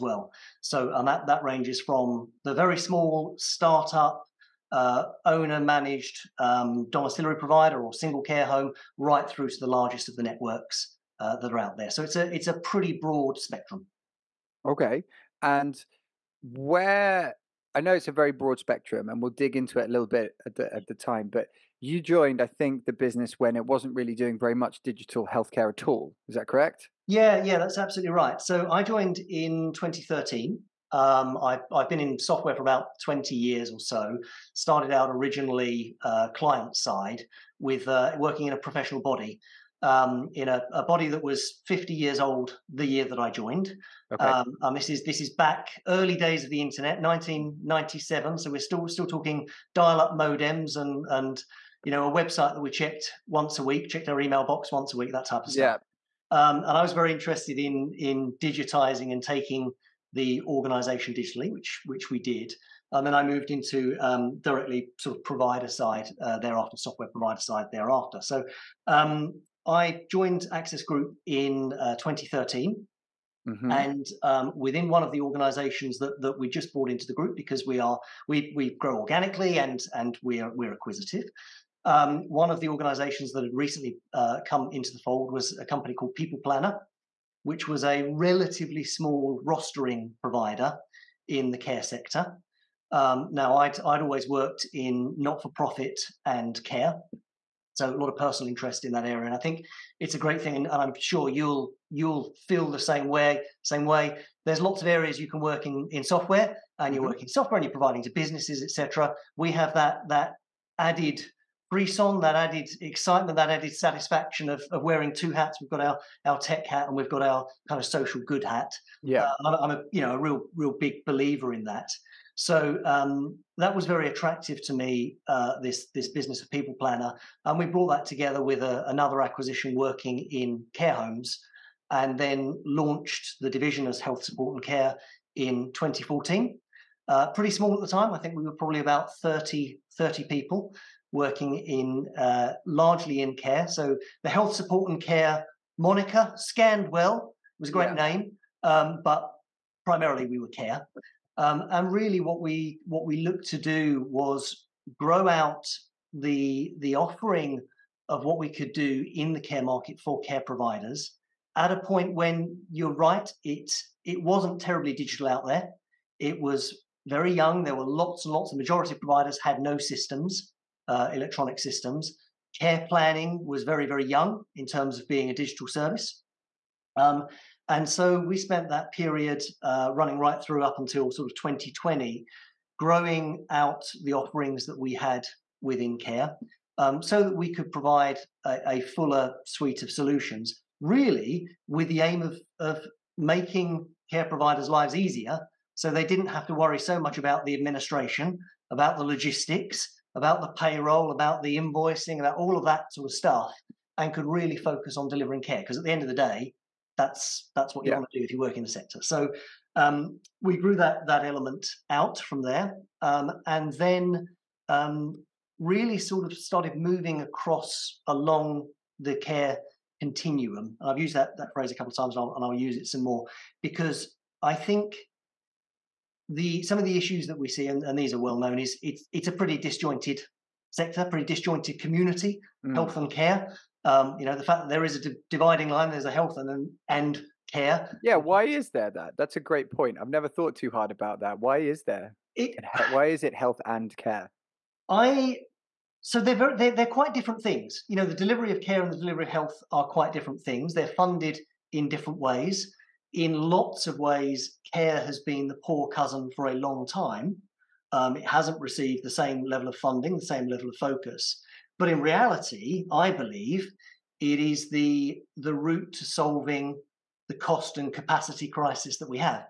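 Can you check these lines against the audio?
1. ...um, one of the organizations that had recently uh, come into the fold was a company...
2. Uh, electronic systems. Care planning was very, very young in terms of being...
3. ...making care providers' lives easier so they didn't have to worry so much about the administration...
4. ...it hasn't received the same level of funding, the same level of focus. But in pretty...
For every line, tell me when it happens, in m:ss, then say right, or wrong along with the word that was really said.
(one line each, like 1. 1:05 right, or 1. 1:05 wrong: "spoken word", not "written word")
1. 1:21 right
2. 2:50 right
3. 3:13 right
4. 4:18 wrong: "reality", not "pretty".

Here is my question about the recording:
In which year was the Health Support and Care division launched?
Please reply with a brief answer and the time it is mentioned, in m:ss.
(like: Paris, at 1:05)
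2014, at 2:15.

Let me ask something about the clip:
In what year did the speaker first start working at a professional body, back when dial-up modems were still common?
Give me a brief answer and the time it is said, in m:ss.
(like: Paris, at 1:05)
1997, at 0:47.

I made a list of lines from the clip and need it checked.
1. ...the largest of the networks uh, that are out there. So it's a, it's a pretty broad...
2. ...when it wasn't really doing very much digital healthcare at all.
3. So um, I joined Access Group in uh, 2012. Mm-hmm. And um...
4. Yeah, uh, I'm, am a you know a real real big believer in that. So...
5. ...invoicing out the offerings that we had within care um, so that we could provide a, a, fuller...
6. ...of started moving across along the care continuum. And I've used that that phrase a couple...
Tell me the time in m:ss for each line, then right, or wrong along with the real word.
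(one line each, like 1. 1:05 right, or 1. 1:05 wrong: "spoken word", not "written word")
1. 0:09 right
2. 0:23 right
3. 1:08 wrong: "2013", not "2012"
4. 1:59 right
5. 3:02 wrong: "growing", not "invoicing"
6. 3:36 right.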